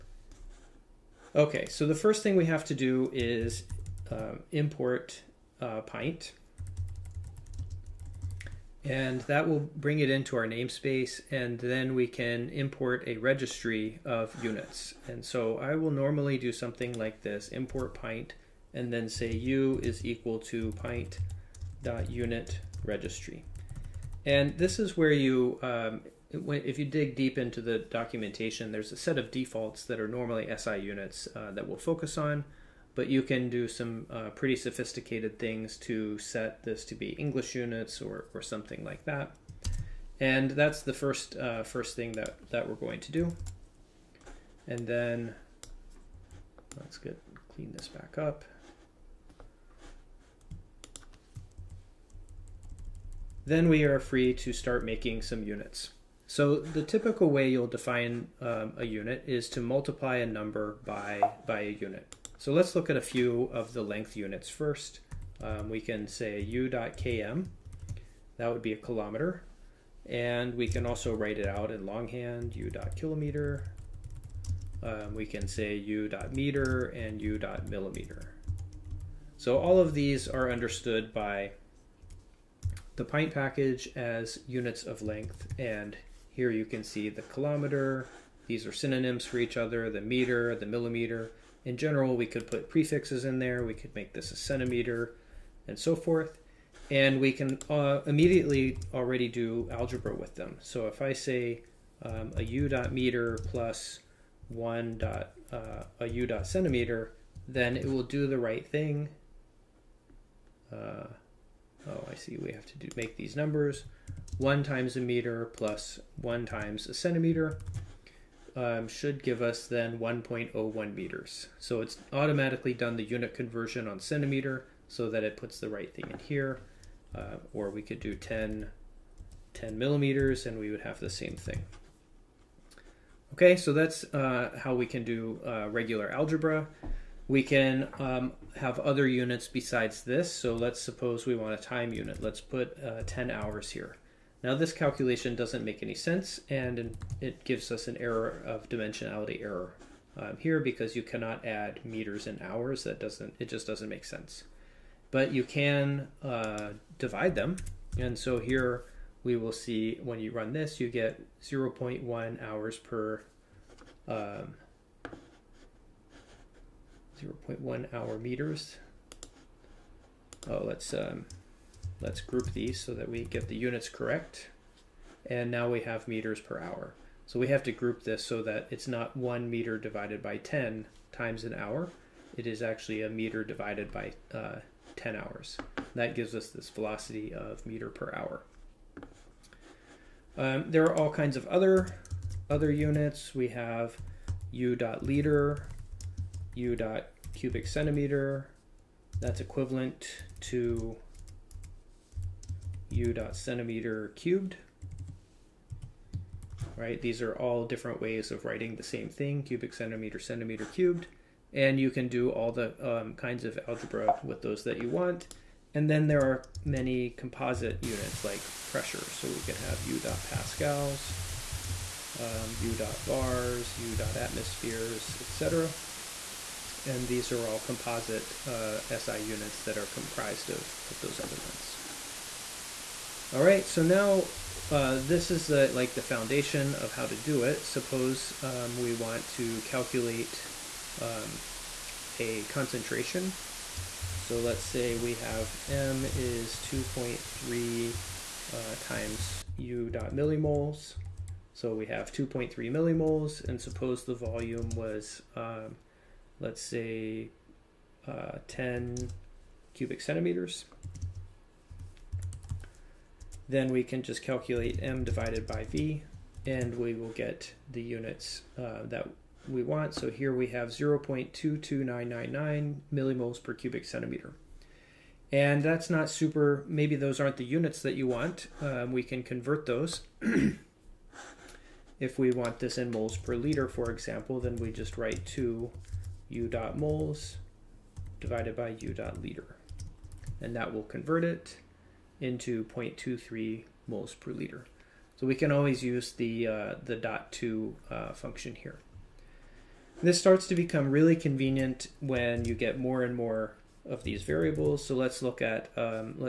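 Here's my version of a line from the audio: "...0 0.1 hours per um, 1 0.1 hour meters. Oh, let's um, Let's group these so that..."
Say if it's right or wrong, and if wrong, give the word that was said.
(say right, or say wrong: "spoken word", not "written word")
wrong: "0", not "1".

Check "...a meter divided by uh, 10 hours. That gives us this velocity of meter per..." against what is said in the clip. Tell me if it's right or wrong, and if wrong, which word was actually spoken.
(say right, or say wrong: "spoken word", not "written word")
right.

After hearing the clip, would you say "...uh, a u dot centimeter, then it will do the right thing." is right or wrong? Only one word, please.
right.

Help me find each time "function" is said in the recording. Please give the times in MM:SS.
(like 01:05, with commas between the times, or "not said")
04:58.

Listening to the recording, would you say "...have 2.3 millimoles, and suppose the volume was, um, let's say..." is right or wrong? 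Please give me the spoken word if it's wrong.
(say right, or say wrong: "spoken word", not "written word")
right.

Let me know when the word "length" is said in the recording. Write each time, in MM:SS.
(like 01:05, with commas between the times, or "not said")
01:03, 01:25.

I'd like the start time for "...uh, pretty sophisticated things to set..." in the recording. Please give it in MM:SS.
00:34.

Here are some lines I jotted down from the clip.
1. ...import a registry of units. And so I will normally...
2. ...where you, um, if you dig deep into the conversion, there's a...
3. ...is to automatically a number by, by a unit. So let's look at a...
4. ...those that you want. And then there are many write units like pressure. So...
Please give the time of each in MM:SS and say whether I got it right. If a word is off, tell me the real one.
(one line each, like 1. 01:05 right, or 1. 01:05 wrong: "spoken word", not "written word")
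1. 00:12 right
2. 00:24 wrong: "documentation", not "conversion"
3. 00:59 wrong: "multiply", not "automatically"
4. 03:34 wrong: "composite", not "write".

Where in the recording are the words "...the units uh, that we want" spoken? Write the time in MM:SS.
04:27.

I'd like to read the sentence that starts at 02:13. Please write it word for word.
Okay, so that's uh, how we can do uh, regular algebra.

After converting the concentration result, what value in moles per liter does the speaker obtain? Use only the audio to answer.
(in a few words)
0.23.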